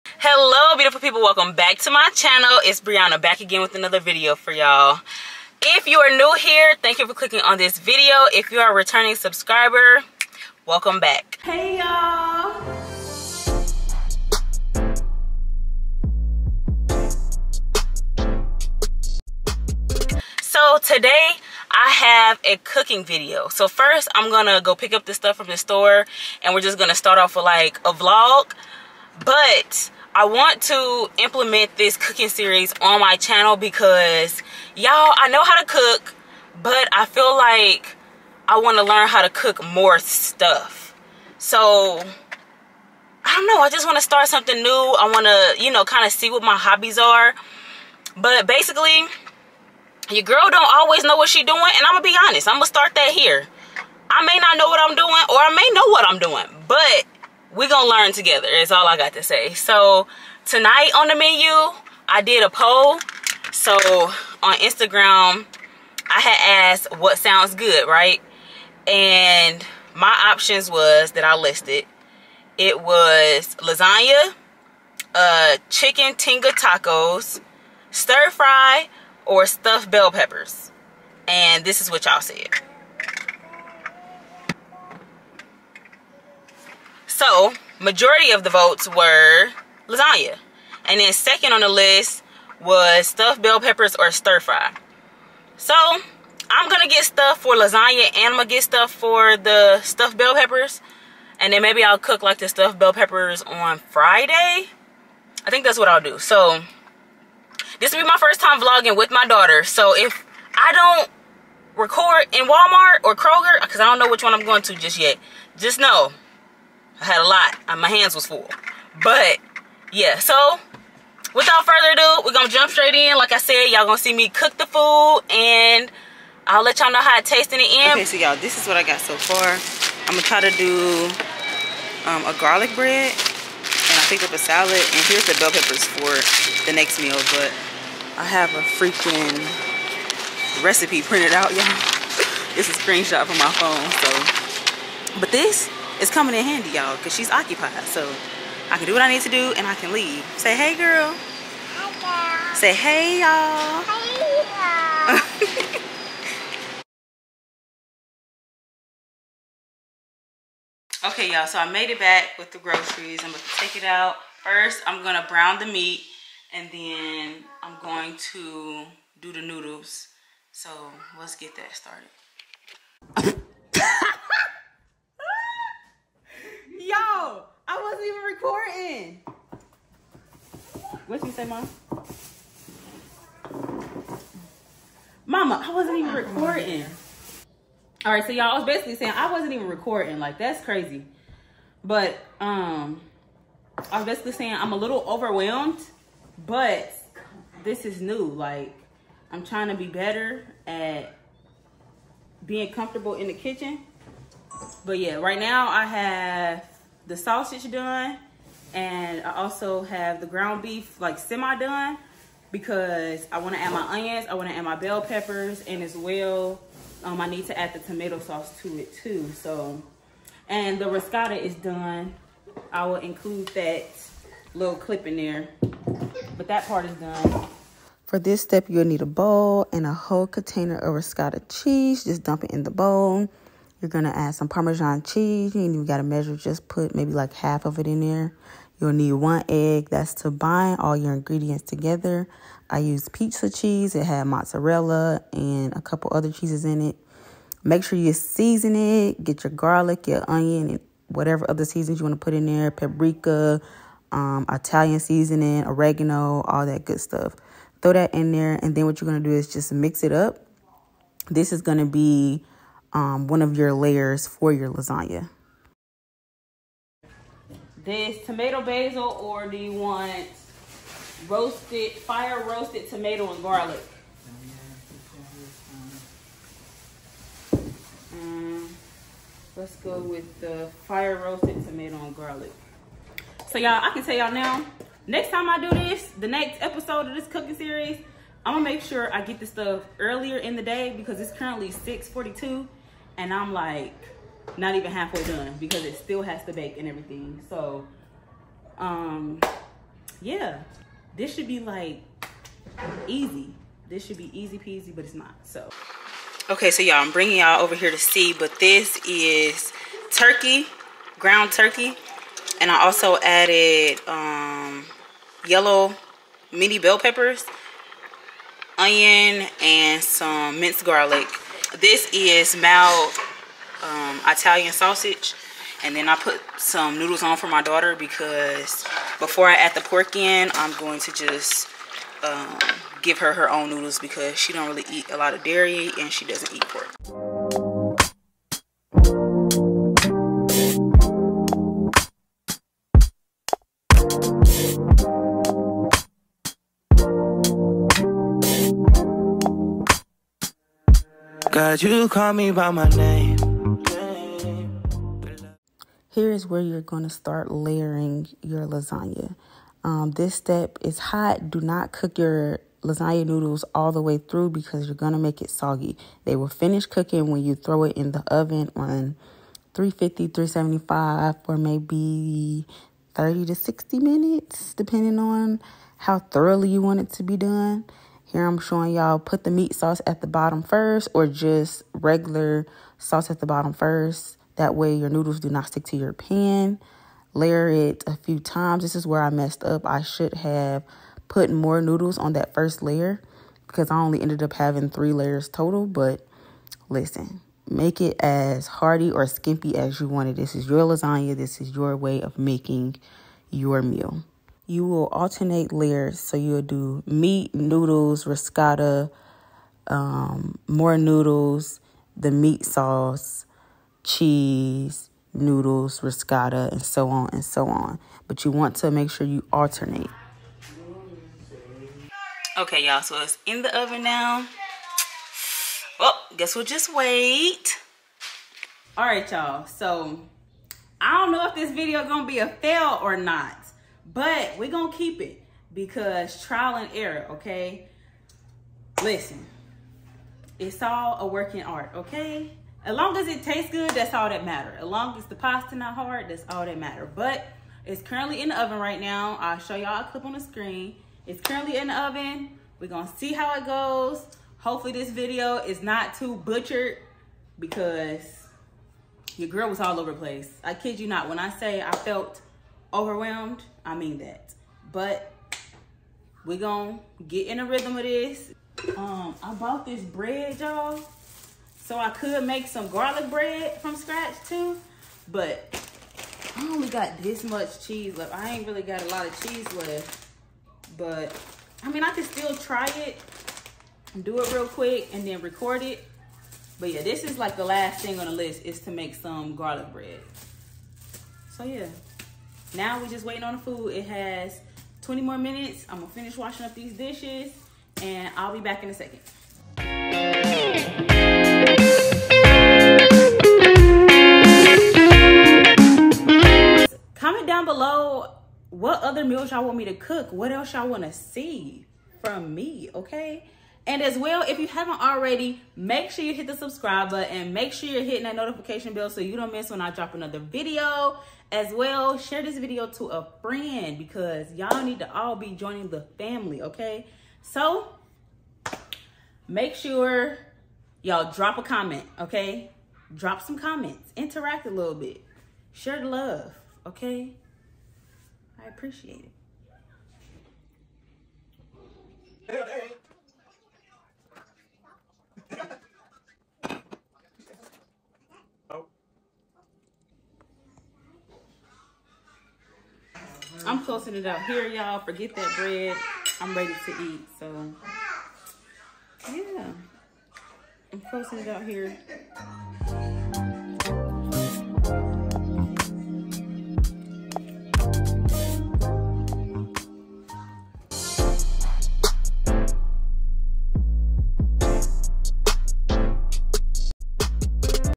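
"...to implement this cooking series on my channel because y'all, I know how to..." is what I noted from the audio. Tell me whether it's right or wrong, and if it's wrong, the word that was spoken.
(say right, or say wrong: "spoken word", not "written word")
right.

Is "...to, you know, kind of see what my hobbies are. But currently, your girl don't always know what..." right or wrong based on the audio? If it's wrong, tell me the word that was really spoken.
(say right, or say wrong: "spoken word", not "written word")
wrong: "basically", not "currently".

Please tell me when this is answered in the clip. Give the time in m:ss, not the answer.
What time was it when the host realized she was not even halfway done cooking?
4:51.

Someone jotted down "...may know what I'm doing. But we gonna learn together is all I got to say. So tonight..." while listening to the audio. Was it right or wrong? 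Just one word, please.
right.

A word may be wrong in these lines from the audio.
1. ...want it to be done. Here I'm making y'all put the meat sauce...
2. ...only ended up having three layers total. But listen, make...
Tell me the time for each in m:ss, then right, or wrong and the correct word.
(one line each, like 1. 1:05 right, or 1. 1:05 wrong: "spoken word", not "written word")
1. 6:16 wrong: "showing", not "making"
2. 6:33 right.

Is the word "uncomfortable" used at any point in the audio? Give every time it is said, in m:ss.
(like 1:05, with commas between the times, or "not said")
not said.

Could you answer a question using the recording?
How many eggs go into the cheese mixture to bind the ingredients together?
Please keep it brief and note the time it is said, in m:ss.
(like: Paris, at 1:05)
1, at 3:59.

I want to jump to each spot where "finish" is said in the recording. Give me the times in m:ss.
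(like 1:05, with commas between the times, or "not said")
6:06, 8:16.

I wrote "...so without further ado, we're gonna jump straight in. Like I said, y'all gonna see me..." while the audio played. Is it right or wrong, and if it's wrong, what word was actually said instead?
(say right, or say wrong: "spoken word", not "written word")
right.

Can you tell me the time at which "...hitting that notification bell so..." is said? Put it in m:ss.
8:38.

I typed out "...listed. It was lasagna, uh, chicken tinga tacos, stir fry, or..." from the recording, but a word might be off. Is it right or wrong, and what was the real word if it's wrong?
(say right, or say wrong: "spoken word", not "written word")
right.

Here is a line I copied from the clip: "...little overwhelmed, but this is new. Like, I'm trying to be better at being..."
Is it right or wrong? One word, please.
right.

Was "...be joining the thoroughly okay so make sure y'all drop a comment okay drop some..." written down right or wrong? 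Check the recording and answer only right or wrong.
wrong.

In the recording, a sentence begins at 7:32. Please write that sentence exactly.
We're gonna see how it goes.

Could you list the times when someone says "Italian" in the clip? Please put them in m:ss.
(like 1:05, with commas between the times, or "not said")
4:14, 5:24.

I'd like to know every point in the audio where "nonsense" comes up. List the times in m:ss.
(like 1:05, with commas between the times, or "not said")
not said.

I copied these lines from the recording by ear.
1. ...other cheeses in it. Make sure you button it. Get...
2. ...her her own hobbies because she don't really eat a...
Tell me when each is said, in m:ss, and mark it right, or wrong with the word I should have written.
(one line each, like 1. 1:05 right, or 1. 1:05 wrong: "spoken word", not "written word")
1. 4:06 wrong: "season", not "button"
2. 5:33 wrong: "noodles", not "hobbies".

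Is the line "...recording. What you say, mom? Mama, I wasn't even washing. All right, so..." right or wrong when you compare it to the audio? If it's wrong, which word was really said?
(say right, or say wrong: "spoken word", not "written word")
wrong: "recording", not "washing".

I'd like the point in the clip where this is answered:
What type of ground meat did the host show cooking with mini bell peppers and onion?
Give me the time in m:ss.
5:11.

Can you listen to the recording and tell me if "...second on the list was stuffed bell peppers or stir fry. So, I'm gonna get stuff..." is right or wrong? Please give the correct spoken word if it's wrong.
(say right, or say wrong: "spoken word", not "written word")
right.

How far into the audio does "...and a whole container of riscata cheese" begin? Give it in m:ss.
3:49.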